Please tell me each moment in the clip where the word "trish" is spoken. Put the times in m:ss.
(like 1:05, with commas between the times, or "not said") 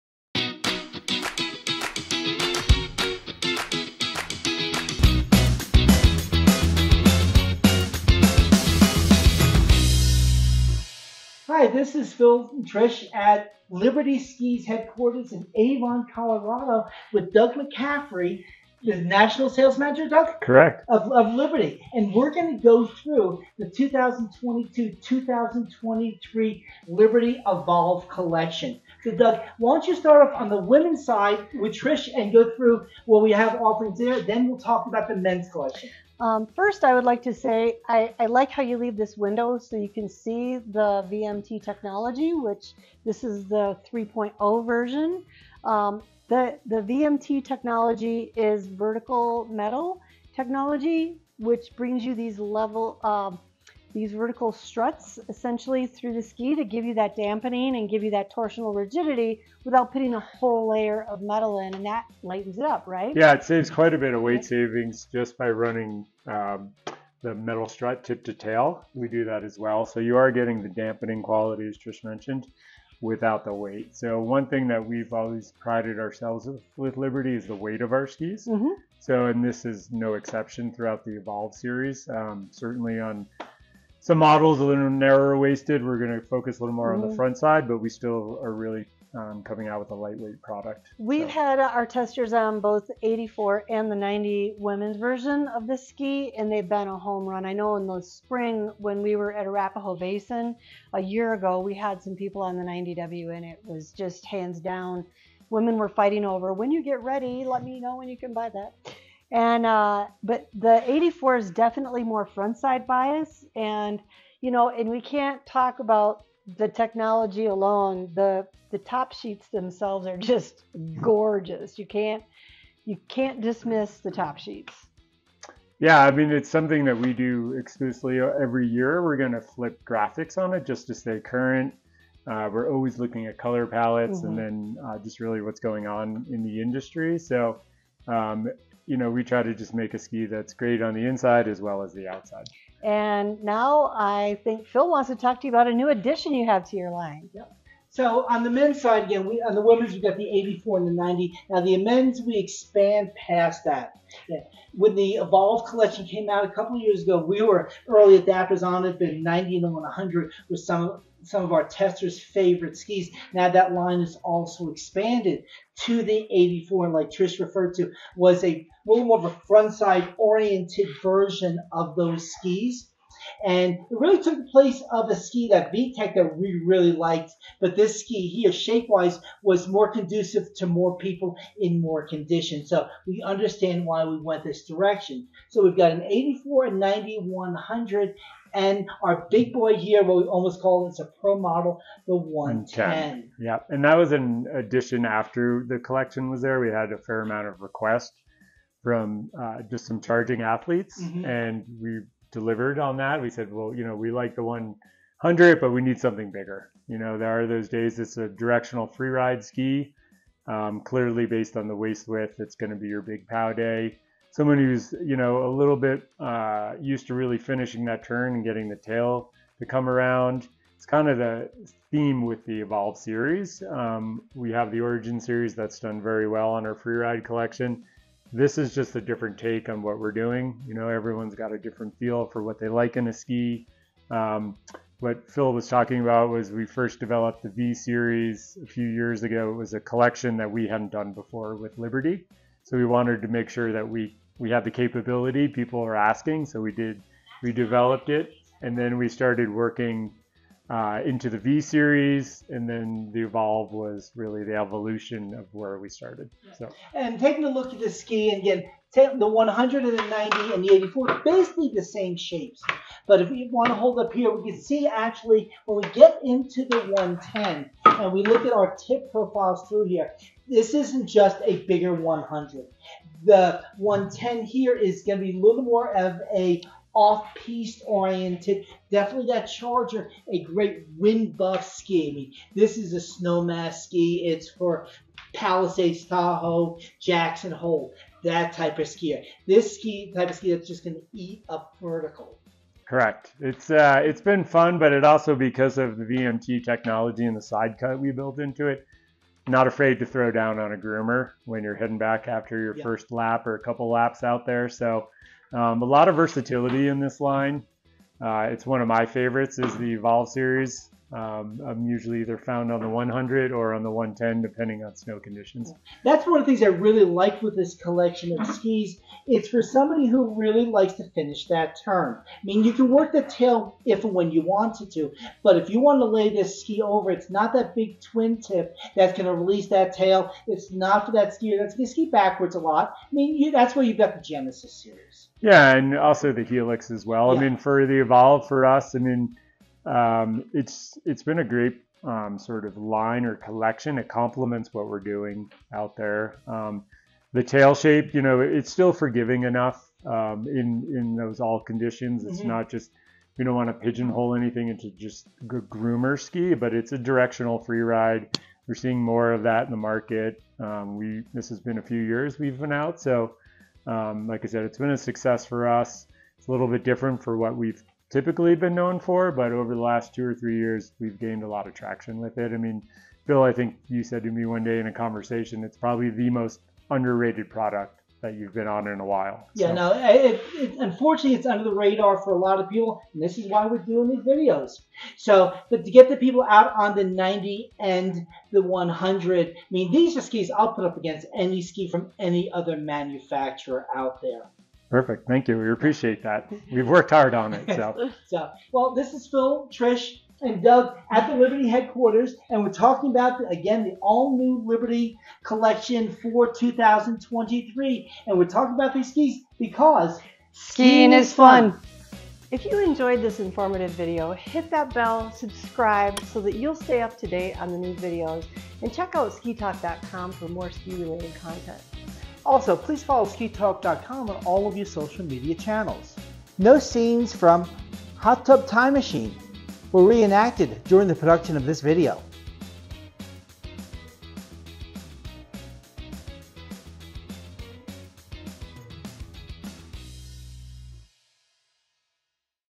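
0:12, 0:31, 1:11, 2:47, 6:39.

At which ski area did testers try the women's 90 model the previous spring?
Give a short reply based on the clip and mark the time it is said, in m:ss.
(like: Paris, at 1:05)
Arapahoe Basin, at 1:39.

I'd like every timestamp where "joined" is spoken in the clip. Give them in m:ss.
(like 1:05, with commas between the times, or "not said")
not said.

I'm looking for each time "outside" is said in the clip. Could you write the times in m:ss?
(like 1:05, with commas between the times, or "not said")
2:22.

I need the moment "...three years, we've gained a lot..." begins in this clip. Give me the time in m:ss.
6:10.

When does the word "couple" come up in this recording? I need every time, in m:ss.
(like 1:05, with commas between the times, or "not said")
2:36, 5:03.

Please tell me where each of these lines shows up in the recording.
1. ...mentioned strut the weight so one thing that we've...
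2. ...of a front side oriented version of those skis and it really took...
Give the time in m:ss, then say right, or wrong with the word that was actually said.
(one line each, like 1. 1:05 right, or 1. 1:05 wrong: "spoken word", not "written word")
1. 1:12 wrong: "without", not "strut"
2. 2:49 right.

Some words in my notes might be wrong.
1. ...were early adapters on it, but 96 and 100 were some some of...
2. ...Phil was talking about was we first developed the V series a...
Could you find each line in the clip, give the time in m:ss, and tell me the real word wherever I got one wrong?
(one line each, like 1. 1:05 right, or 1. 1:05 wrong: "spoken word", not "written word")
1. 2:37 wrong: "90", not "96"
2. 3:55 right.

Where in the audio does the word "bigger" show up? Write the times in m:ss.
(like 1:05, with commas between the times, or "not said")
3:26, 4:31.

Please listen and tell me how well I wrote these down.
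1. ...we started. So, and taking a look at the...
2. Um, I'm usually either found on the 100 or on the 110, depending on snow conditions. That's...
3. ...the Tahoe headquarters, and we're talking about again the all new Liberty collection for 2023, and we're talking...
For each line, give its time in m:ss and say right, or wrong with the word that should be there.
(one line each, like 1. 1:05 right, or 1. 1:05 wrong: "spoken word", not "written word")
1. 4:15 right
2. 5:11 right
3. 6:41 wrong: "Liberty", not "Tahoe".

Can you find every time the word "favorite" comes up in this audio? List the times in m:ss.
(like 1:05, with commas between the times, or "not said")
2:42, 5:09.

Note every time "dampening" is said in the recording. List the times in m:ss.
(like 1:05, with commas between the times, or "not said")
0:57, 1:10.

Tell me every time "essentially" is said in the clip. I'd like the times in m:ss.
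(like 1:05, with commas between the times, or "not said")
0:55.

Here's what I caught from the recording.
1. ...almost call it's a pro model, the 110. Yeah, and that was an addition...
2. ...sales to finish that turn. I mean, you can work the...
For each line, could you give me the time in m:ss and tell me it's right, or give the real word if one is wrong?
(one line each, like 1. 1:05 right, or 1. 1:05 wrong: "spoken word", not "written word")
1. 3:10 right
2. 5:20 wrong: "likes", not "sales".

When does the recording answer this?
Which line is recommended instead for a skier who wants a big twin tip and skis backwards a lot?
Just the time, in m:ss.
5:34.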